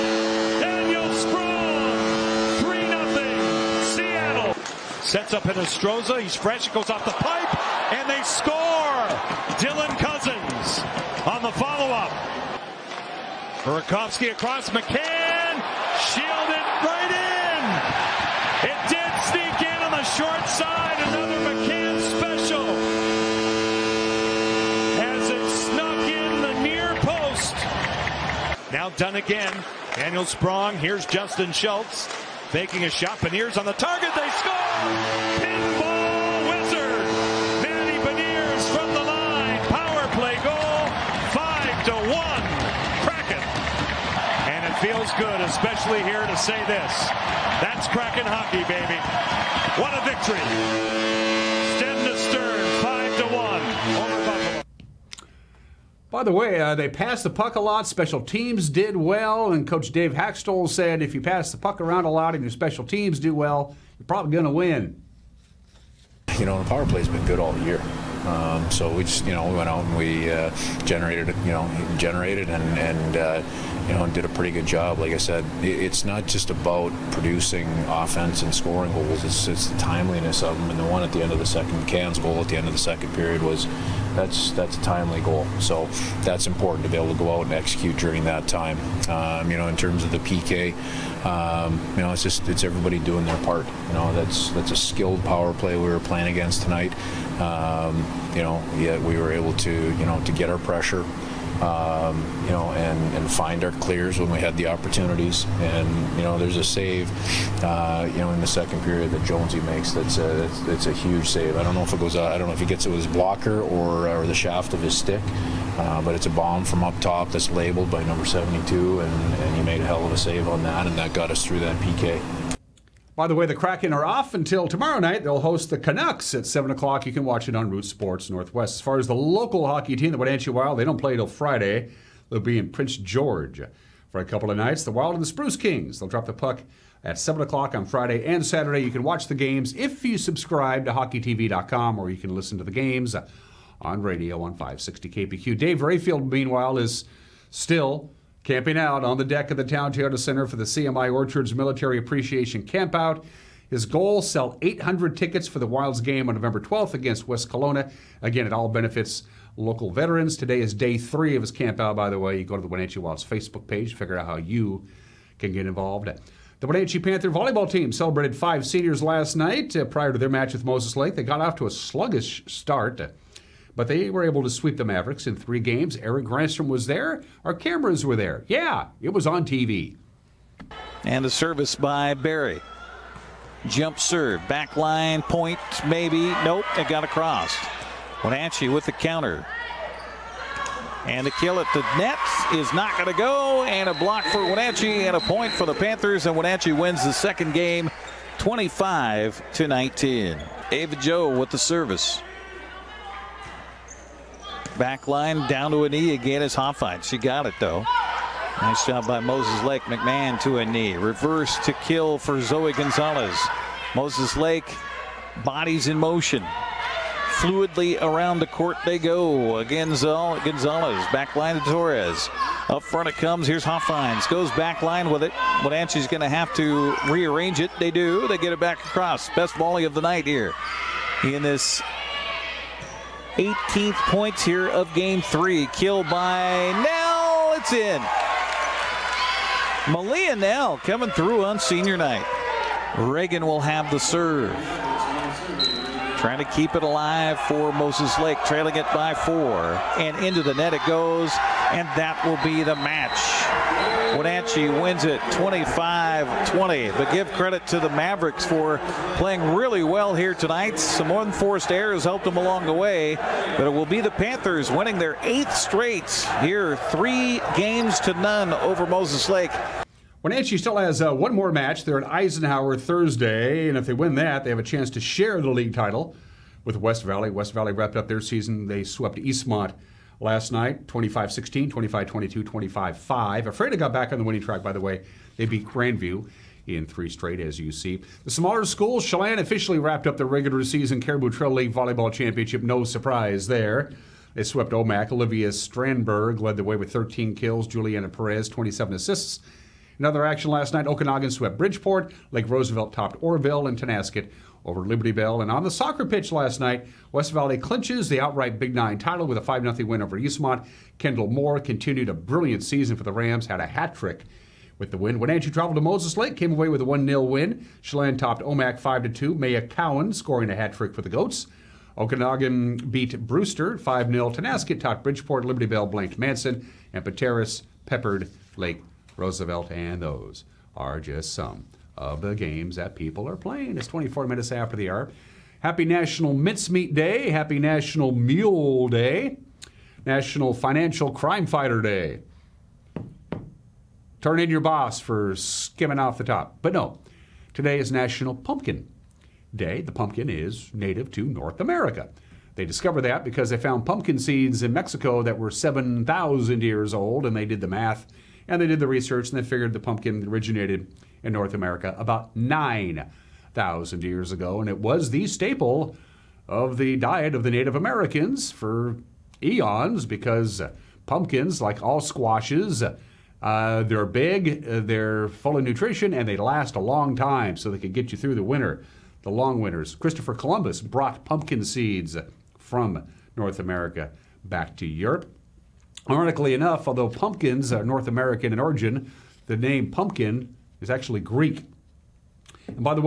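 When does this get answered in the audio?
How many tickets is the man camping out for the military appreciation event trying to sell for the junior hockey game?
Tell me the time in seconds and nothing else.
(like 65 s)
154 s.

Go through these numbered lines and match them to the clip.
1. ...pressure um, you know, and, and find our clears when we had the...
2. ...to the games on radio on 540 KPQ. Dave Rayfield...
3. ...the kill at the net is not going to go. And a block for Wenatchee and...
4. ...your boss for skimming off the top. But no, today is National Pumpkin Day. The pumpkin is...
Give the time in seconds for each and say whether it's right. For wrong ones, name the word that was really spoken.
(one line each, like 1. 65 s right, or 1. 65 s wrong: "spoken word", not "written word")
1. 100 s right
2. 142 s wrong: "560", not "540"
3. 191 s right
4. 344 s right.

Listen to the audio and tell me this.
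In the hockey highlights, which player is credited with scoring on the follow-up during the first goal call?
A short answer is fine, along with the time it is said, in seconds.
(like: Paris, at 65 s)
Dylan Cozens, at 9 s.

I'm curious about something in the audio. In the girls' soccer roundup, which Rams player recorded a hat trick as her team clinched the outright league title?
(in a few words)
Kendall Moore.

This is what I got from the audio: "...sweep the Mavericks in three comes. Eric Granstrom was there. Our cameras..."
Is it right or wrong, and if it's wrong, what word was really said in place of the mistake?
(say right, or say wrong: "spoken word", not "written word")
wrong: "games", not "comes".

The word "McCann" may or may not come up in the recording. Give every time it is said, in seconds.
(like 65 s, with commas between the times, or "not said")
14 s, 21 s.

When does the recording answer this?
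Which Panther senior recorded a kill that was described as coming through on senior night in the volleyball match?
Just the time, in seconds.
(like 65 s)
239 s.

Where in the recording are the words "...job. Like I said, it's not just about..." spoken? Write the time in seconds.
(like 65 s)
74 s.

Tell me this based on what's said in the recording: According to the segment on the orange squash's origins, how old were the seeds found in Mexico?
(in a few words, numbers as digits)
7,000 years.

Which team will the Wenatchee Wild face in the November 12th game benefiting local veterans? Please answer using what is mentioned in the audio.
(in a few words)
West Kelowna.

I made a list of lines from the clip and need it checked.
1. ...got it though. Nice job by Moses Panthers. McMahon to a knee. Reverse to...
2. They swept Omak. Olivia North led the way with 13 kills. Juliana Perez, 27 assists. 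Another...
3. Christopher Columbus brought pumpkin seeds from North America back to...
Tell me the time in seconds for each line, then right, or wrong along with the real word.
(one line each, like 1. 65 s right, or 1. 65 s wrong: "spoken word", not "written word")
1. 207 s wrong: "Lake", not "Panthers"
2. 294 s wrong: "Strandberg", not "North"
3. 379 s right.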